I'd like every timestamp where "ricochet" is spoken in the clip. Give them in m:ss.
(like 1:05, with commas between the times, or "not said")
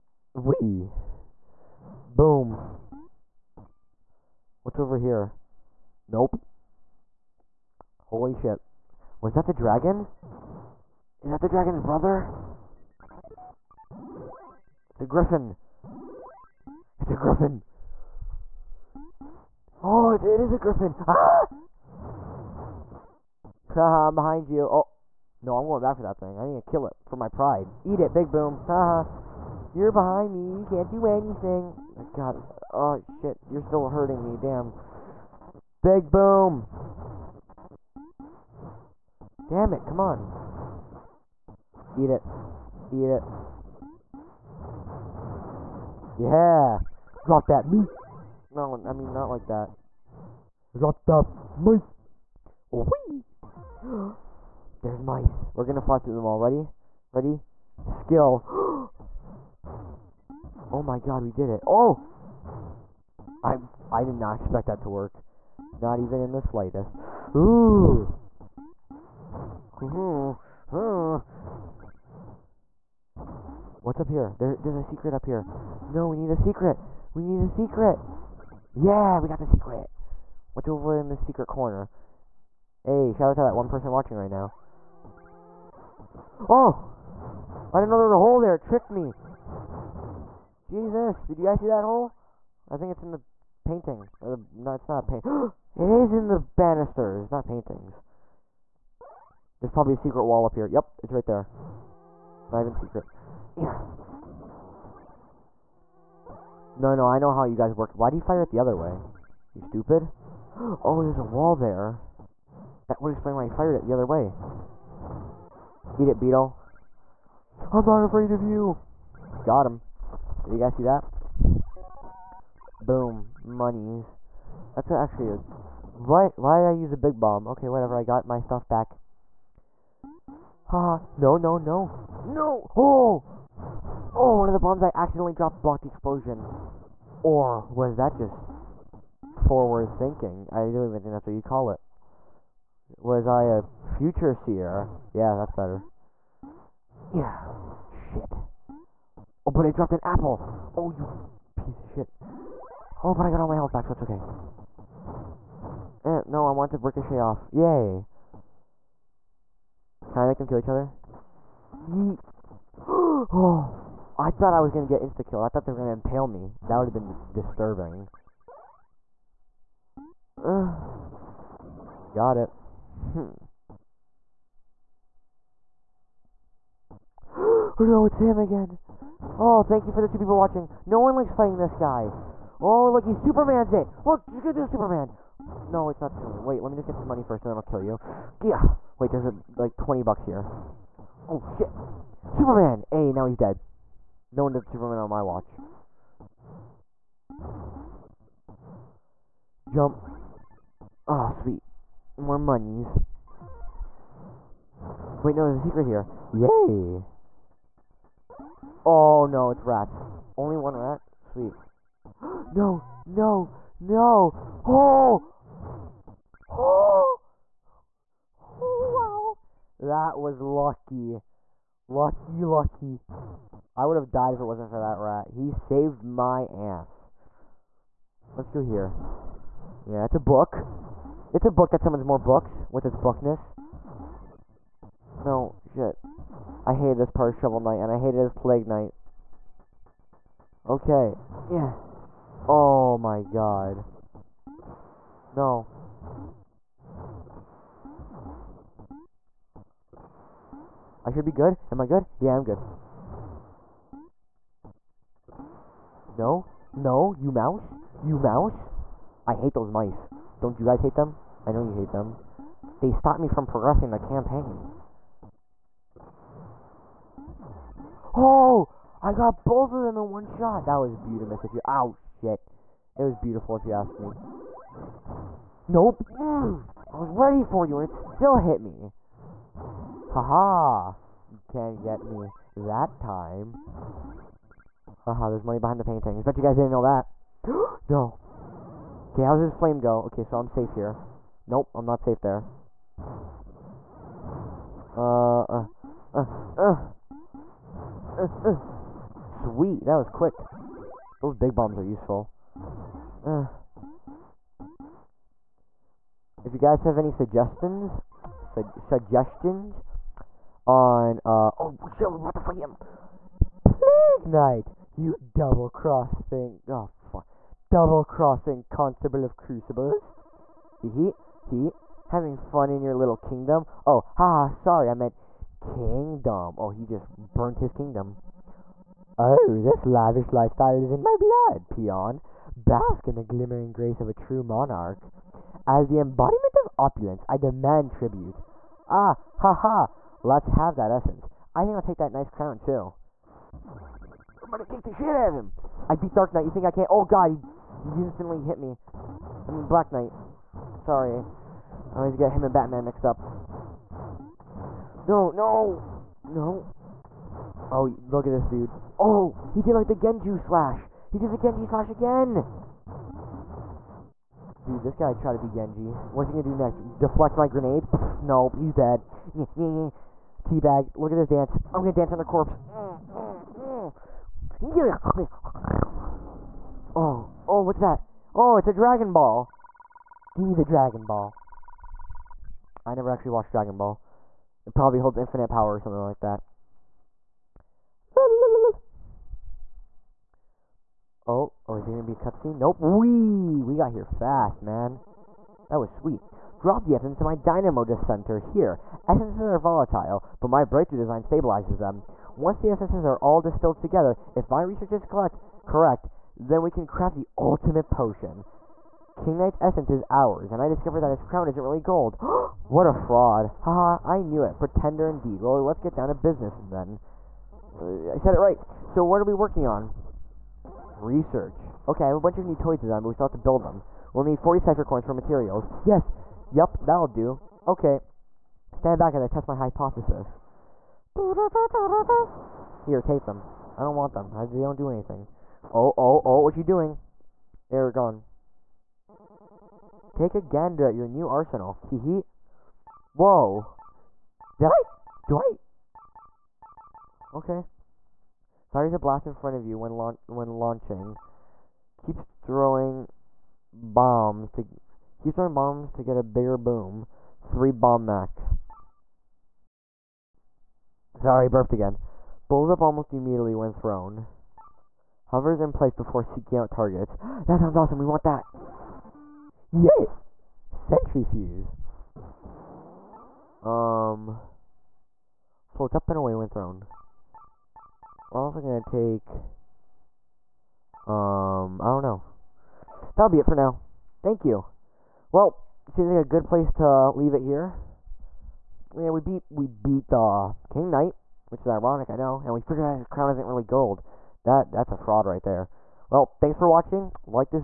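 2:36.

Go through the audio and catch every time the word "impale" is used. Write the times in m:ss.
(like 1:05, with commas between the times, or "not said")
2:45.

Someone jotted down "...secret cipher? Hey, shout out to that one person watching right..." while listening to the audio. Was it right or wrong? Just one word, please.
wrong.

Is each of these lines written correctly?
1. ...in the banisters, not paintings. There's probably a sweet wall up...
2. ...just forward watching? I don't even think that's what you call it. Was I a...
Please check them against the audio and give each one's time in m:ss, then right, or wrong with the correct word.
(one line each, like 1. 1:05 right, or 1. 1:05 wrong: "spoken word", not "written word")
1. 1:36 wrong: "secret", not "sweet"
2. 2:18 wrong: "thinking", not "watching".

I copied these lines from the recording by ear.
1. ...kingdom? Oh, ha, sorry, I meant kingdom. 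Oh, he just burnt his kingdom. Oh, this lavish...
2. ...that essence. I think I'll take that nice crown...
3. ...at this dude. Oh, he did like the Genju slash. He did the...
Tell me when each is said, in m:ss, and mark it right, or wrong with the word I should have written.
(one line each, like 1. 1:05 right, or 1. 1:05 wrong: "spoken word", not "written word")
1. 5:23 right
2. 5:40 right
3. 5:58 right.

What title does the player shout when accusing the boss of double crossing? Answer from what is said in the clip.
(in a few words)
Constable of Crucibles.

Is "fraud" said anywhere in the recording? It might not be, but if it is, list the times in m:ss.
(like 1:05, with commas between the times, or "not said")
6:52, 8:14.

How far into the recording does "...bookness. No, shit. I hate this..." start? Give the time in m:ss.
3:52.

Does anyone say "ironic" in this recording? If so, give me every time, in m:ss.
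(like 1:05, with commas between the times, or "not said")
8:11.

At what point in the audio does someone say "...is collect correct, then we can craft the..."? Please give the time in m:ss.
6:44.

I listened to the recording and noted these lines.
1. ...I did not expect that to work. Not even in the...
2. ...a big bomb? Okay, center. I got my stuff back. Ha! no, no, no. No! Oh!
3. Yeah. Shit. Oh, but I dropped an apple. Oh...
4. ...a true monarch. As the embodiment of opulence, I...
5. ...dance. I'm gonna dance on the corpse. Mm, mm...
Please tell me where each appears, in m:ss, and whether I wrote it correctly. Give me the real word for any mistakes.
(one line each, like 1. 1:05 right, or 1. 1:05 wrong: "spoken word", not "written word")
1. 1:03 right
2. 2:06 wrong: "whatever", not "center"
3. 2:27 right
4. 5:34 right
5. 6:11 right.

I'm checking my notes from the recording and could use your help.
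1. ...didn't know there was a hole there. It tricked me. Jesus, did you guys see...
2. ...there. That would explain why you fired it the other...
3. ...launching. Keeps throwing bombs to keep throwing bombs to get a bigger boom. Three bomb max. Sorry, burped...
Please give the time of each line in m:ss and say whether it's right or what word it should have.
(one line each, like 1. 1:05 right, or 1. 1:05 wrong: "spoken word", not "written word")
1. 1:27 right
2. 1:51 right
3. 7:30 right.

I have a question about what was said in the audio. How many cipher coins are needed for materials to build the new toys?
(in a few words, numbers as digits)
40.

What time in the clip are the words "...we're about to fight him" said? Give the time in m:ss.
5:12.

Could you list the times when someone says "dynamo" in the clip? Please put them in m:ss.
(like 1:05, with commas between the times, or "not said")
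6:37.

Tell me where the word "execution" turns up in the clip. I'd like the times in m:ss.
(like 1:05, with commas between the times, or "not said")
not said.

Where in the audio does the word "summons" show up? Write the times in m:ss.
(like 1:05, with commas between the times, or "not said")
3:51.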